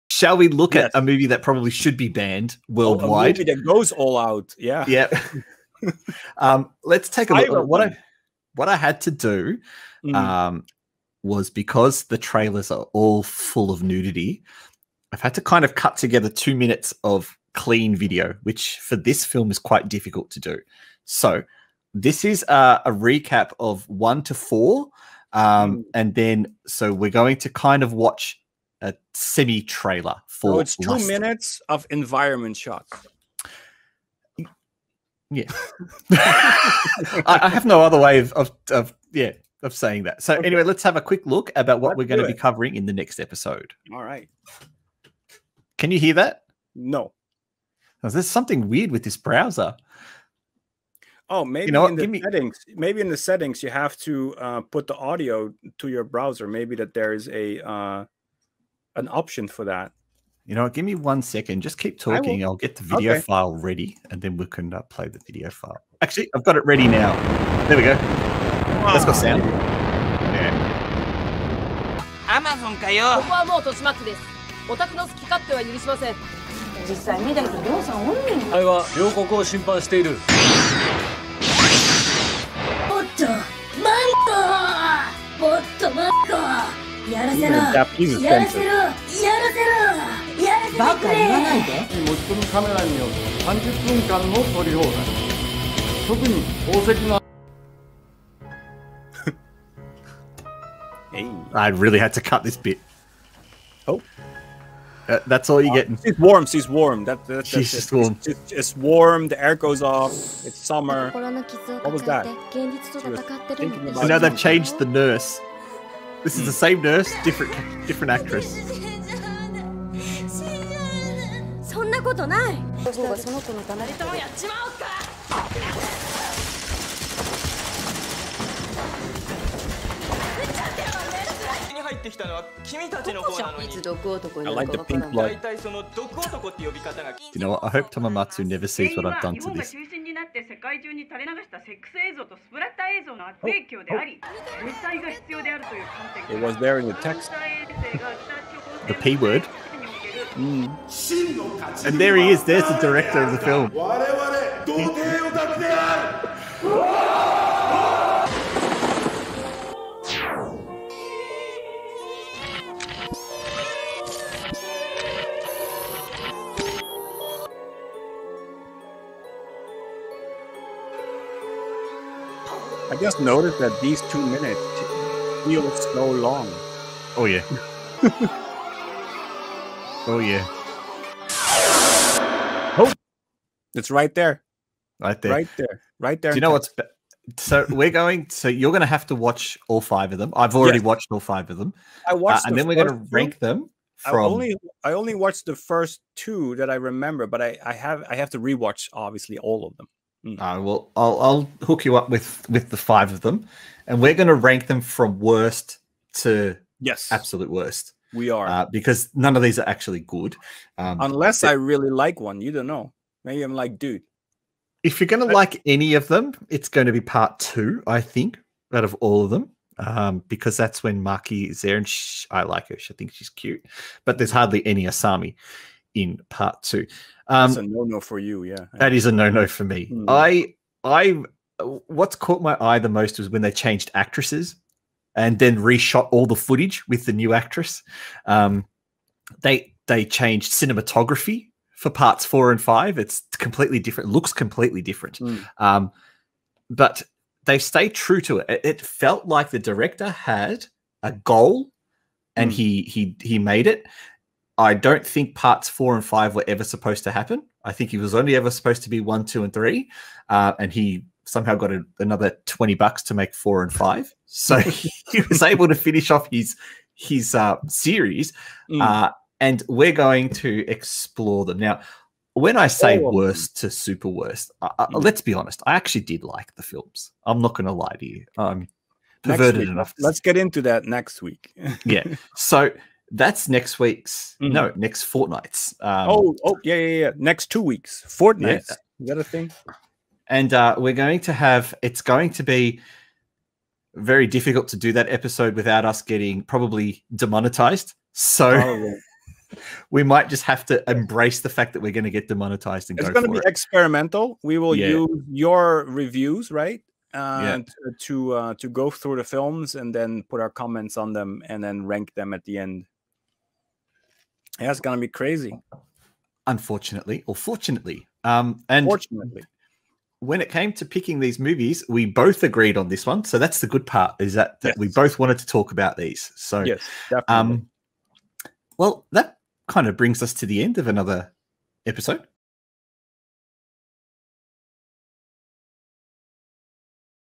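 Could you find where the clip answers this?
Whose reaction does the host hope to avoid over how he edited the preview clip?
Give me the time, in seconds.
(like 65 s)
137 s.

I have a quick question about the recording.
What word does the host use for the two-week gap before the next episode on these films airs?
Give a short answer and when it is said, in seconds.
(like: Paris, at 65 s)
fortnight, at 285 s.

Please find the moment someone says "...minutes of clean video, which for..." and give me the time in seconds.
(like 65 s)
16 s.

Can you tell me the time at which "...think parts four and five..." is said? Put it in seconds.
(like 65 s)
255 s.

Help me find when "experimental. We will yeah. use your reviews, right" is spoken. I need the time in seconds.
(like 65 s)
303 s.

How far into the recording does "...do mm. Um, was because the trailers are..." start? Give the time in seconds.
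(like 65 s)
9 s.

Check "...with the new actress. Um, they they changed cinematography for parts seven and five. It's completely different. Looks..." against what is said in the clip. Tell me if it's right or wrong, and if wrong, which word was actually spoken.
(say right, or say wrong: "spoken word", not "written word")
wrong: "four", not "seven".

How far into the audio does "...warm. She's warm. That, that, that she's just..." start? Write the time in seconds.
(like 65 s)
106 s.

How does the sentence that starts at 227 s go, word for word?
Um, That's a no no for you, yeah.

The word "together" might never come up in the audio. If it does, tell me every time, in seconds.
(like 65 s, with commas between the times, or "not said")
15 s.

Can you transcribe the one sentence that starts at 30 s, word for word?
So oh, it's two minutes of environment shots.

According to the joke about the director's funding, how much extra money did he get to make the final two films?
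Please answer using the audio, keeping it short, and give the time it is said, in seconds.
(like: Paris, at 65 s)
20 bucks, at 262 s.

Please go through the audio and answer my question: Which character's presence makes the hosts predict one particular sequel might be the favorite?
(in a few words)
Maki.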